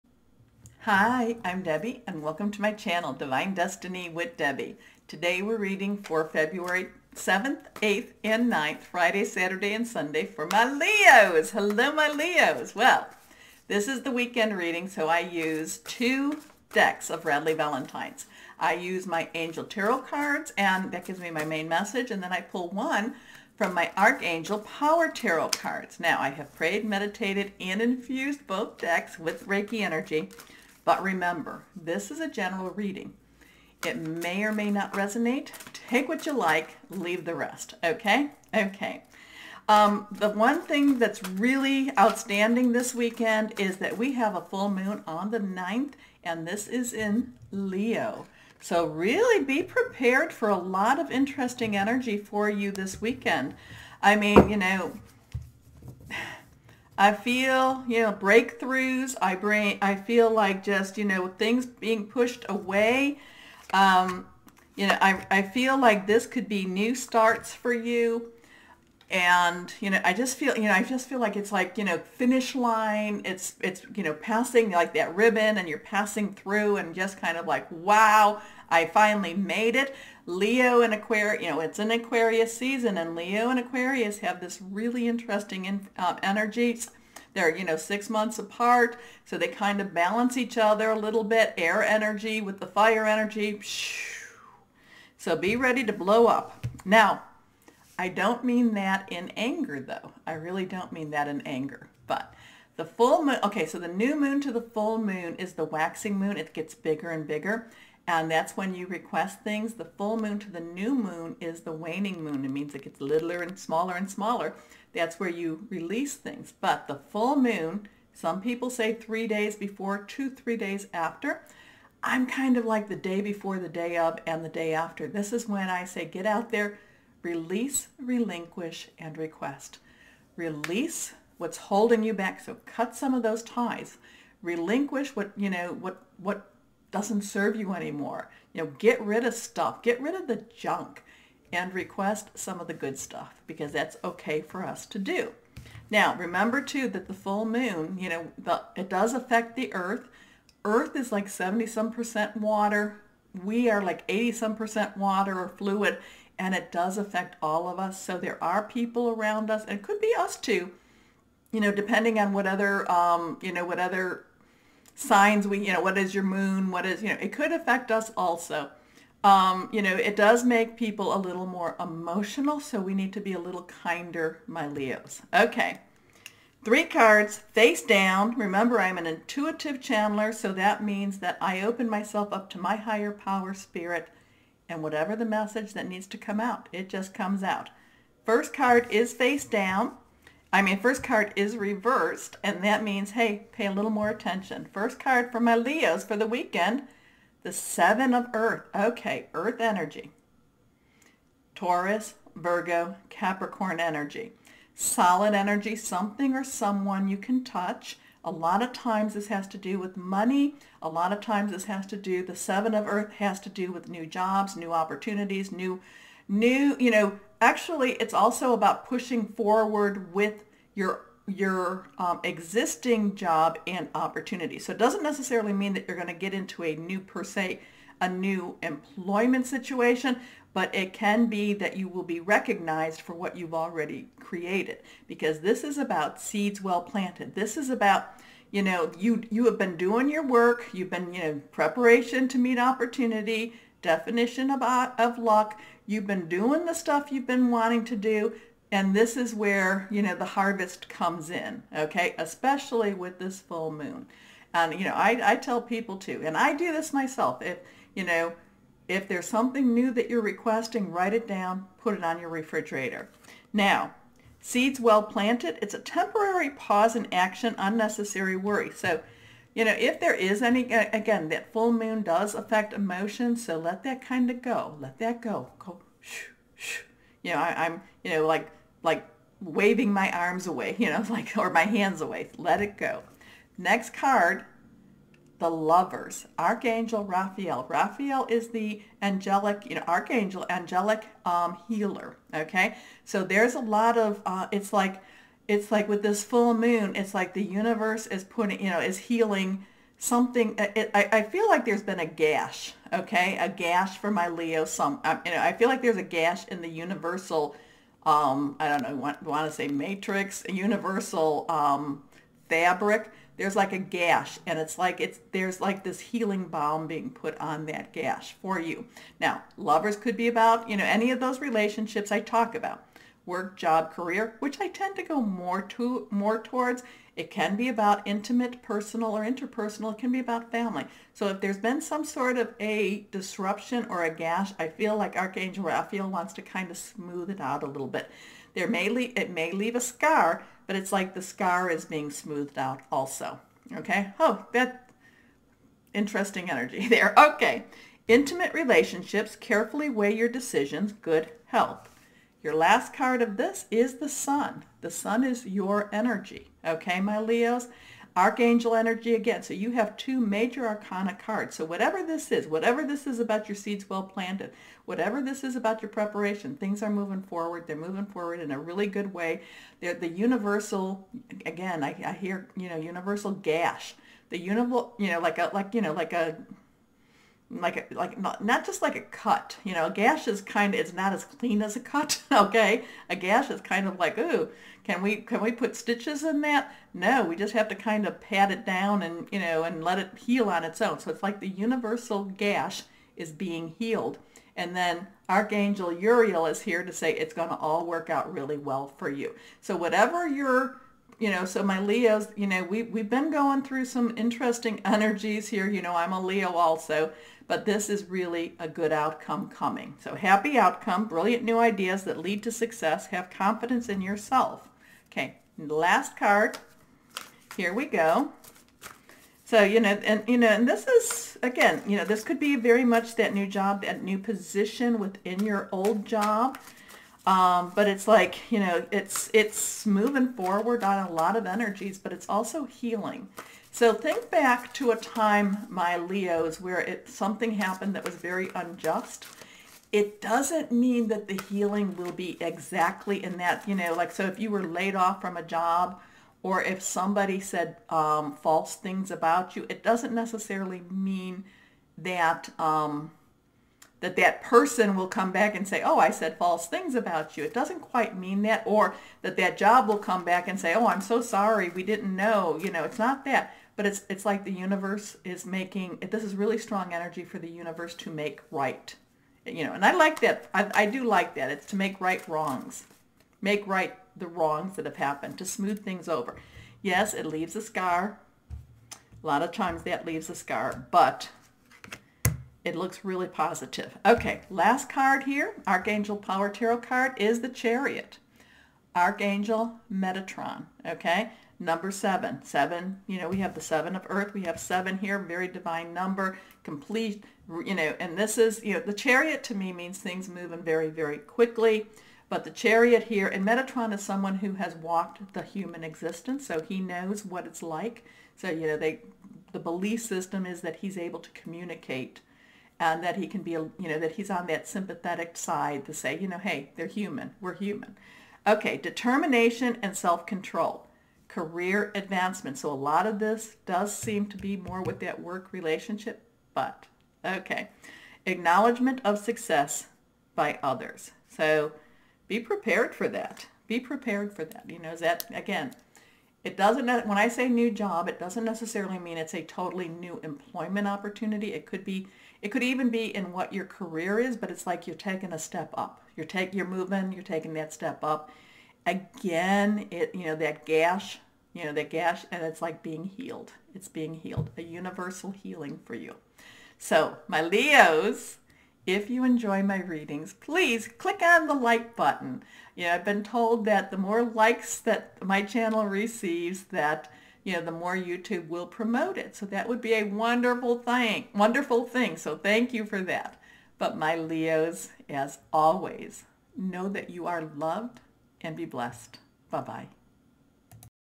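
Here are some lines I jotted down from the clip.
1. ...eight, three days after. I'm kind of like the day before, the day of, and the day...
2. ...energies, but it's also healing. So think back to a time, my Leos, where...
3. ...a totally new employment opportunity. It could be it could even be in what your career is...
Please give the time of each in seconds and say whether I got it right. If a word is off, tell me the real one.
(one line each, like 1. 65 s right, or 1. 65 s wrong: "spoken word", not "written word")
1. 120 s wrong: "two", not "eight"
2. 431 s right
3. 539 s right.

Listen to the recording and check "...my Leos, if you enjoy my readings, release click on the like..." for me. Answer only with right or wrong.
wrong.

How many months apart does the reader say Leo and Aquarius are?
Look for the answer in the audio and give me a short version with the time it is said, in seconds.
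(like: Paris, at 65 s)
6, at 87 s.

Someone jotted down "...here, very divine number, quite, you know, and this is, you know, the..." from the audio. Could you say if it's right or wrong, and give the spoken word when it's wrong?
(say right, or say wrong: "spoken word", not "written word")
wrong: "complete", not "quite".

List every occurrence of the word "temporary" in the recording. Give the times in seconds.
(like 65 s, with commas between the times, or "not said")
265 s.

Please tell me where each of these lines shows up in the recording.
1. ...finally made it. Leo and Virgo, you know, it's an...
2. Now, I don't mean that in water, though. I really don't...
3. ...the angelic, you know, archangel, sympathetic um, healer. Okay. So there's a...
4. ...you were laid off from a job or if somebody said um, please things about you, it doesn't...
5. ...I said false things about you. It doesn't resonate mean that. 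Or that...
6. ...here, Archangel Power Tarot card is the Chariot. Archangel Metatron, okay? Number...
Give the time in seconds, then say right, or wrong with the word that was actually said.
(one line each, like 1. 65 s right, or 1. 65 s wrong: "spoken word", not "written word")
1. 78 s wrong: "Aquarius", not "Virgo"
2. 96 s wrong: "anger", not "water"
3. 288 s wrong: "angelic", not "sympathetic"
4. 444 s wrong: "false", not "please"
5. 455 s wrong: "quite", not "resonate"
6. 485 s right.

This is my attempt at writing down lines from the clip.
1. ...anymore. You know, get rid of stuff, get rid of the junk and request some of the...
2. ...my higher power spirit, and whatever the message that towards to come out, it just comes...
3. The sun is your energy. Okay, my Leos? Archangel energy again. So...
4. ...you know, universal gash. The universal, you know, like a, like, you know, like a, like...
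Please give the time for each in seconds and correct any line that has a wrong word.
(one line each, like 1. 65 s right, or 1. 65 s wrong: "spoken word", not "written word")
1. 137 s right
2. 182 s wrong: "needs", not "towards"
3. 354 s right
4. 372 s right.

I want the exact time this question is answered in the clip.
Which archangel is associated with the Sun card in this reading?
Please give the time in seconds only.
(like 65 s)
395 s.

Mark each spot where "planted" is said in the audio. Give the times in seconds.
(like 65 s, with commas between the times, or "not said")
236 s, 265 s, 364 s.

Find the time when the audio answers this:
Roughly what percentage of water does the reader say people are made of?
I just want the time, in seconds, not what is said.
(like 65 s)
154 s.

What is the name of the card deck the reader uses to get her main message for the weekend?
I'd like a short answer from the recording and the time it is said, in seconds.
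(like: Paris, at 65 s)
Angel Tarot cards, at 19 s.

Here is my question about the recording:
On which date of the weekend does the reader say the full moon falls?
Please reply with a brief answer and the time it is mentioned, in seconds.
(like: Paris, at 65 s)
9th, at 45 s.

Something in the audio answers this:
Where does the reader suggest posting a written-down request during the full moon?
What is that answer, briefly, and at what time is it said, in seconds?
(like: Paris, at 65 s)
refrigerator, at 262 s.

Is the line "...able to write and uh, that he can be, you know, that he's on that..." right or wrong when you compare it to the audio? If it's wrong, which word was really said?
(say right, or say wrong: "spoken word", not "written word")
wrong: "communicate", not "write".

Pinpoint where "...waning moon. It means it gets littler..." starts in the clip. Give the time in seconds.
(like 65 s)
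111 s.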